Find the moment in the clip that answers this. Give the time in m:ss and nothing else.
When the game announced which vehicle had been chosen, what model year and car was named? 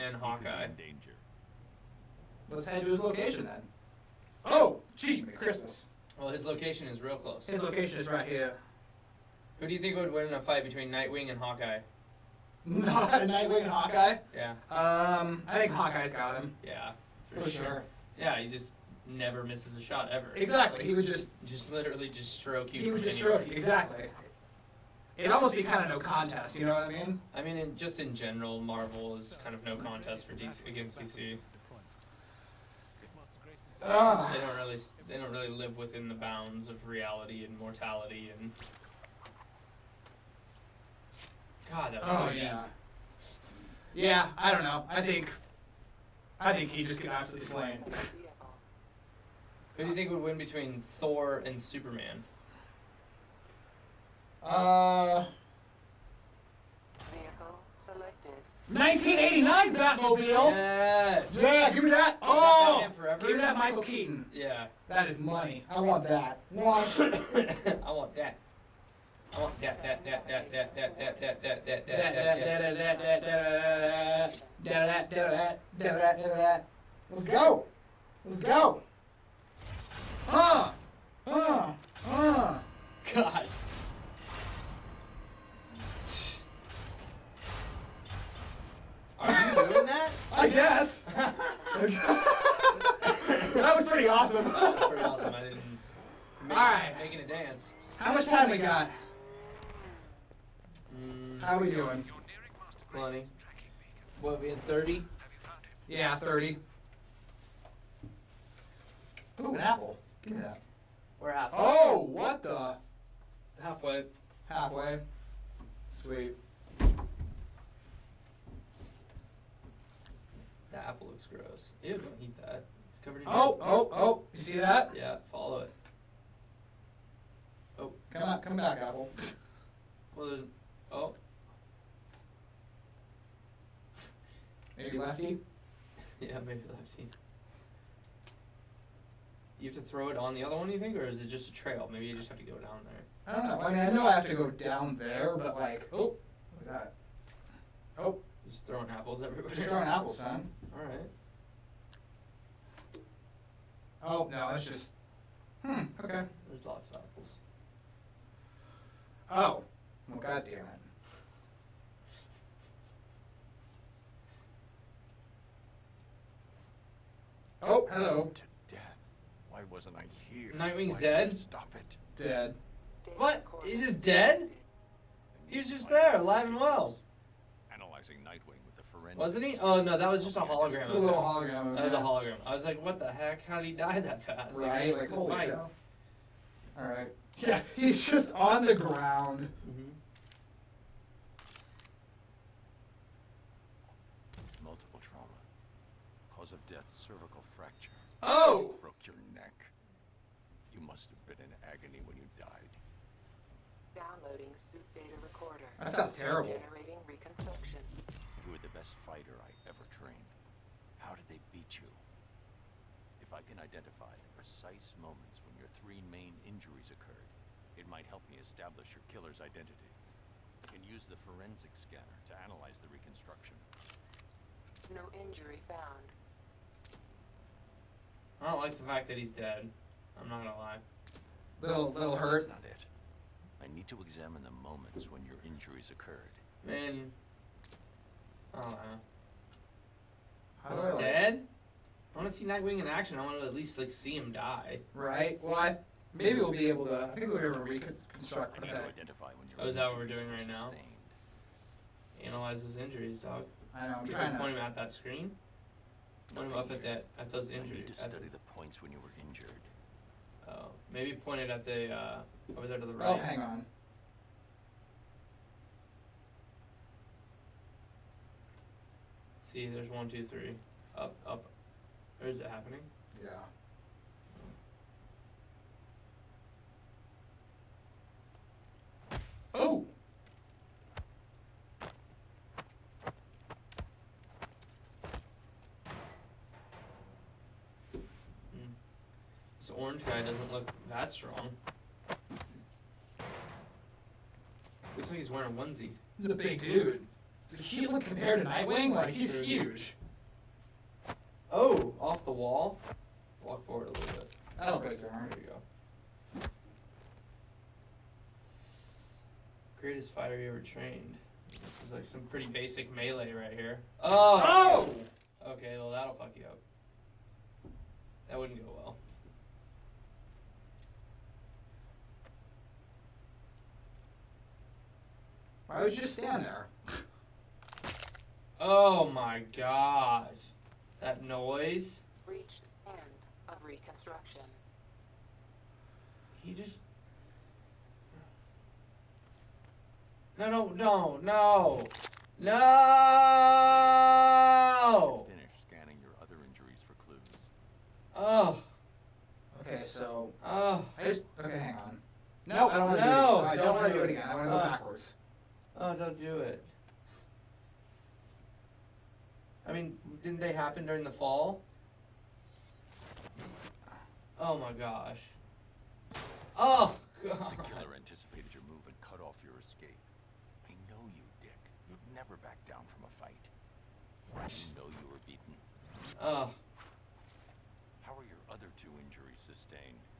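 0:58.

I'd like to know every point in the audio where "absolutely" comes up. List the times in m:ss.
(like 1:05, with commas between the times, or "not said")
0:47.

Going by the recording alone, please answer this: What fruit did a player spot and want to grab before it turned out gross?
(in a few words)
An apple.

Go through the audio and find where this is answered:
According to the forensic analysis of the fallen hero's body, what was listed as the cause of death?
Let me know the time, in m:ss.
3:16.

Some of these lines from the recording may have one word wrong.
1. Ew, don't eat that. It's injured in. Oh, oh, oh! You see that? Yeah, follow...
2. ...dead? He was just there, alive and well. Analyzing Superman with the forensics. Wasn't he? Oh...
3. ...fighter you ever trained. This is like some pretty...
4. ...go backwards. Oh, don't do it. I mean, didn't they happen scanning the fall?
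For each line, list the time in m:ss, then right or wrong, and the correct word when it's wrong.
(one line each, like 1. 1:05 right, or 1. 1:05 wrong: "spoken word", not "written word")
1. 2:01 wrong: "covered", not "injured"
2. 2:54 wrong: "Nightwing", not "Superman"
3. 5:10 right
4. 5:54 wrong: "during", not "scanning".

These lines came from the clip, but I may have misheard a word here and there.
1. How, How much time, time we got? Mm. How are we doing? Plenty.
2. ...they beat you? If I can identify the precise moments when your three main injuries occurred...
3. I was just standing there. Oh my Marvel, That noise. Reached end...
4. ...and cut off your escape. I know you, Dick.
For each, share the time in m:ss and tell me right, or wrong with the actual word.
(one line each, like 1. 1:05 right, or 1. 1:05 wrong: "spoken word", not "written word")
1. 1:37 right
2. 3:31 right
3. 5:25 wrong: "God", not "Marvel"
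4. 6:08 right.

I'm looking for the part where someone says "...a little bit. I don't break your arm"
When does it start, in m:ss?
5:03.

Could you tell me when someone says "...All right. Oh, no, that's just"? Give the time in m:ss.
2:30.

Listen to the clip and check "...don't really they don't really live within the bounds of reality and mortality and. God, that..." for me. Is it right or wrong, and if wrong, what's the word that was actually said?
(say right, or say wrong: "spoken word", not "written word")
right.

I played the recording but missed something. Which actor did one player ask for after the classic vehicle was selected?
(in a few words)
Michael Keaton.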